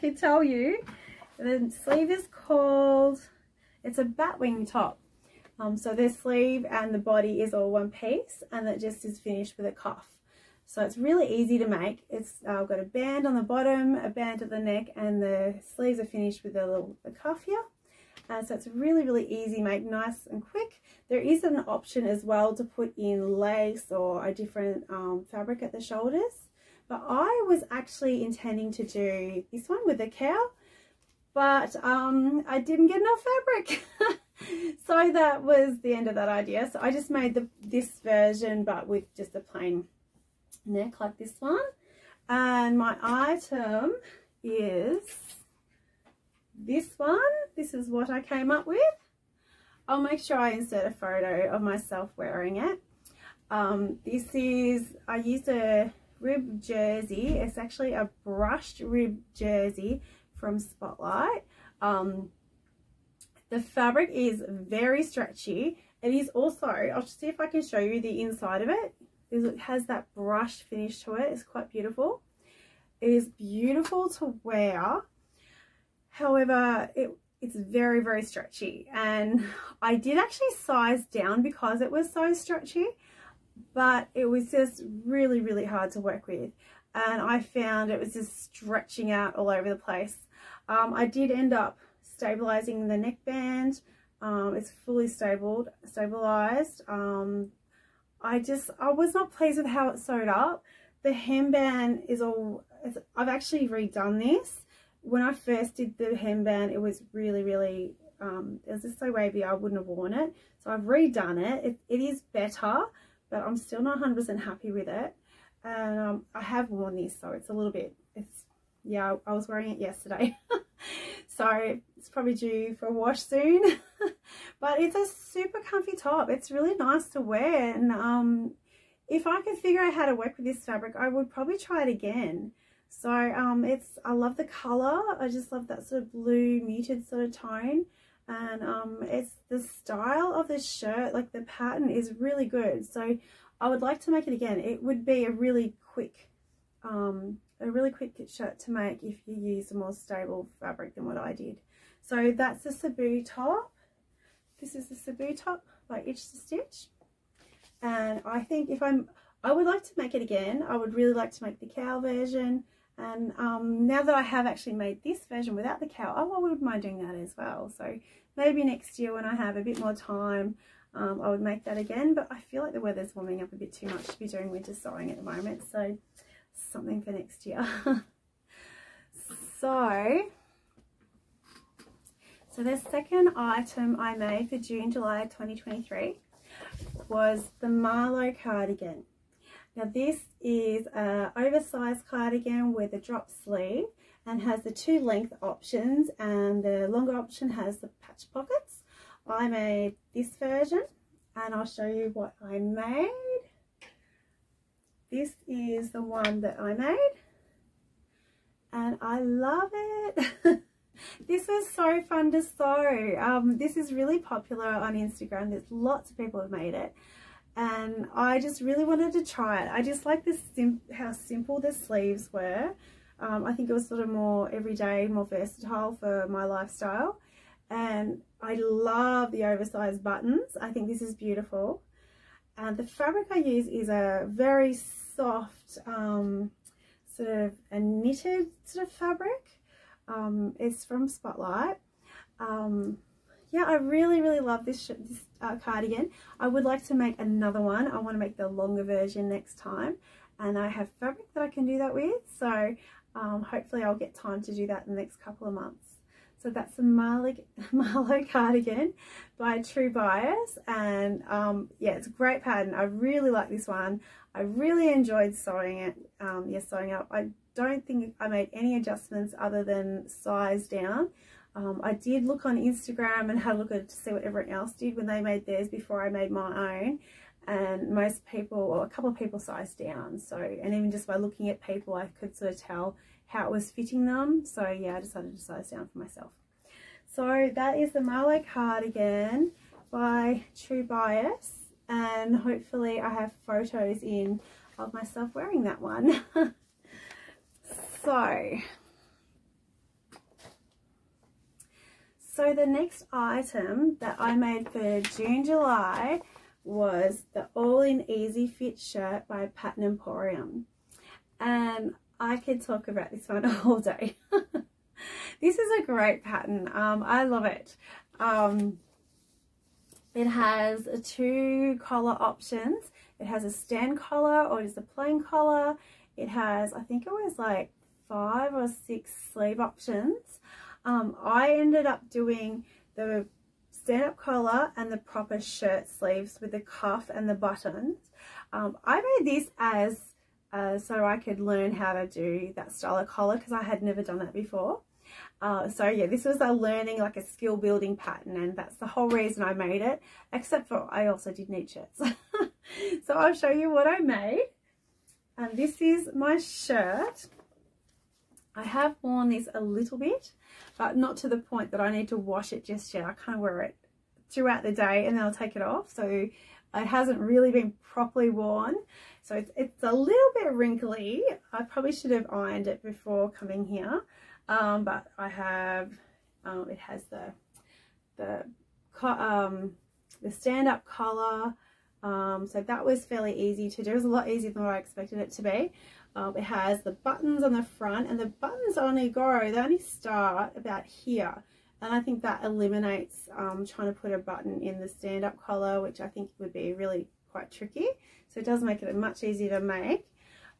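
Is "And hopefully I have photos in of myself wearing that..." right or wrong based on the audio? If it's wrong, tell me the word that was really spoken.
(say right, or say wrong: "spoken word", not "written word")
right.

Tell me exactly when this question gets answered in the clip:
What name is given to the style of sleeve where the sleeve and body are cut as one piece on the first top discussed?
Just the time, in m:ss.
0:04.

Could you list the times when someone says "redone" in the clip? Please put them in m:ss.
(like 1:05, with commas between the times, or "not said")
1:43, 1:50.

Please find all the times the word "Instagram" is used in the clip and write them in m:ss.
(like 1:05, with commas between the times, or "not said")
3:34, 4:32.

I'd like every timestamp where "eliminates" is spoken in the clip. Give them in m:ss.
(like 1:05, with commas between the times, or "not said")
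6:32.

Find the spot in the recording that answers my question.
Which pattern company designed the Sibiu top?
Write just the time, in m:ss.
2:36.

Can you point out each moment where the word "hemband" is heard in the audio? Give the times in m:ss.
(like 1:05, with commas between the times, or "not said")
1:41, 1:46.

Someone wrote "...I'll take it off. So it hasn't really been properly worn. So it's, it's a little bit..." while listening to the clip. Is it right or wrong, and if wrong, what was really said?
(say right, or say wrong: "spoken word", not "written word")
right.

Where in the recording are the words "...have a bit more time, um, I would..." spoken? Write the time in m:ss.
2:49.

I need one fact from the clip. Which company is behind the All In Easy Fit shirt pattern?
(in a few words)
Pattern Emporium.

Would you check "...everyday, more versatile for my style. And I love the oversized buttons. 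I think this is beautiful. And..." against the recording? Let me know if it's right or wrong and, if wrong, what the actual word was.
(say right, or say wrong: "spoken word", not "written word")
wrong: "lifestyle", not "style".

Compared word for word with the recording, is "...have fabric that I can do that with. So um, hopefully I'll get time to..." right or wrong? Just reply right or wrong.
right.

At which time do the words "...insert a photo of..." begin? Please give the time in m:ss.
0:50.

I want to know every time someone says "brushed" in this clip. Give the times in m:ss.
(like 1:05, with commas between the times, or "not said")
0:58, 1:10.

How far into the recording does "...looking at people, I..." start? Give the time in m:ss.
4:41.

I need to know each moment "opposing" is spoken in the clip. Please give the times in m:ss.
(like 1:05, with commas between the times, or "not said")
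not said.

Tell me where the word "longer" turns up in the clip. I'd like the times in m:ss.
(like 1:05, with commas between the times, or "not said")
3:16, 4:08.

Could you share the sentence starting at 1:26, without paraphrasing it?
And I found it was just stretching out all over the place.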